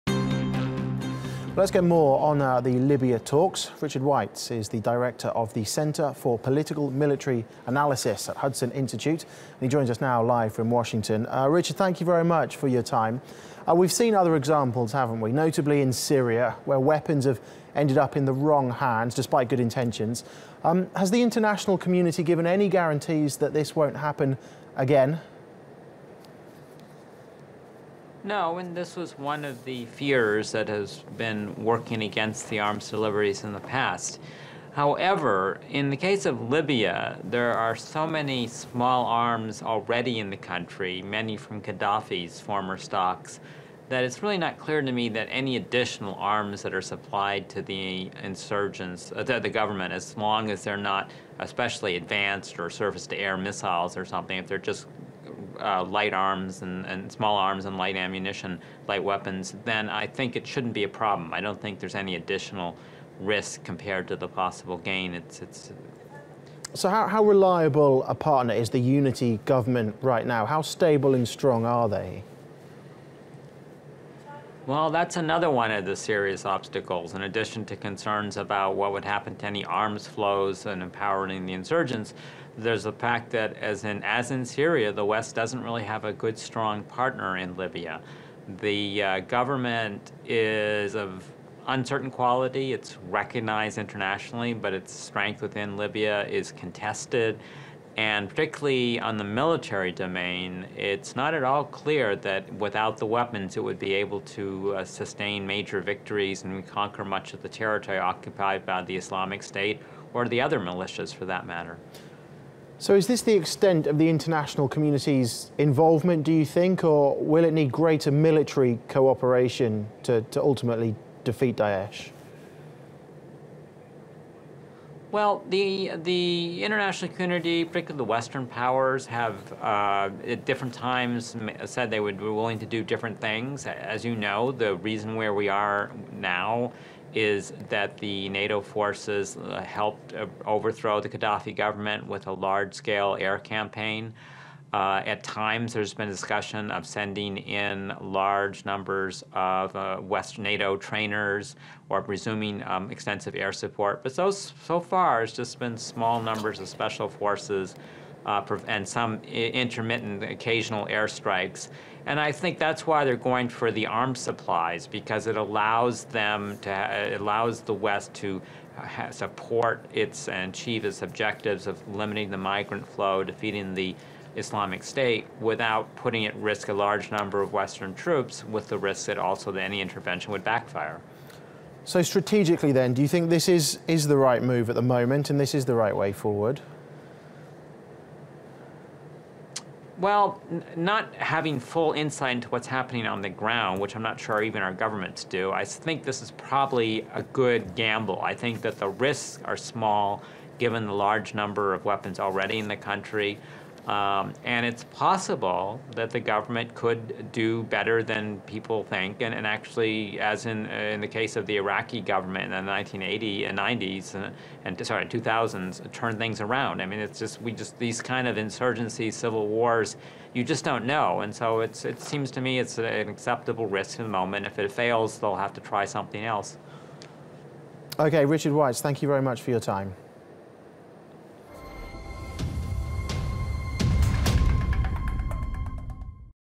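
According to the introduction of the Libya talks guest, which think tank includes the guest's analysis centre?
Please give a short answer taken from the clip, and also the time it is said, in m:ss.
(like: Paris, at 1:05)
Hudson Institute, at 0:08.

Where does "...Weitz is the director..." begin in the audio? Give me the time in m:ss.
0:04.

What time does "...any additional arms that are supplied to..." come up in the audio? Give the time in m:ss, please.
0:45.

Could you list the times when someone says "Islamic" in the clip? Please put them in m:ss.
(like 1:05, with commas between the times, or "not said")
1:48, 2:54.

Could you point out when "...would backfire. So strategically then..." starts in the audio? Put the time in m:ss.
3:00.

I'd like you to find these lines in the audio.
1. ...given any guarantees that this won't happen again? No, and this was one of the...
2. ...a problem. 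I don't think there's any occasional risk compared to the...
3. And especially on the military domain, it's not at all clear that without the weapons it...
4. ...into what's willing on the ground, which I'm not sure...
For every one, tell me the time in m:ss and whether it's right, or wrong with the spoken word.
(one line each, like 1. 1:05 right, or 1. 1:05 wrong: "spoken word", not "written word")
1. 0:22 right
2. 1:00 wrong: "additional", not "occasional"
3. 1:37 wrong: "particularly", not "especially"
4. 3:12 wrong: "happening", not "willing".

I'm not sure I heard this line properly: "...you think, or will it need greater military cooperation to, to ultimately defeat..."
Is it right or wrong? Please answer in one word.
right.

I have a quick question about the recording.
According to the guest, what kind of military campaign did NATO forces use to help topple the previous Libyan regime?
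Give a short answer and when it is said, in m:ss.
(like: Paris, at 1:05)
A large-scale air campaign, at 2:22.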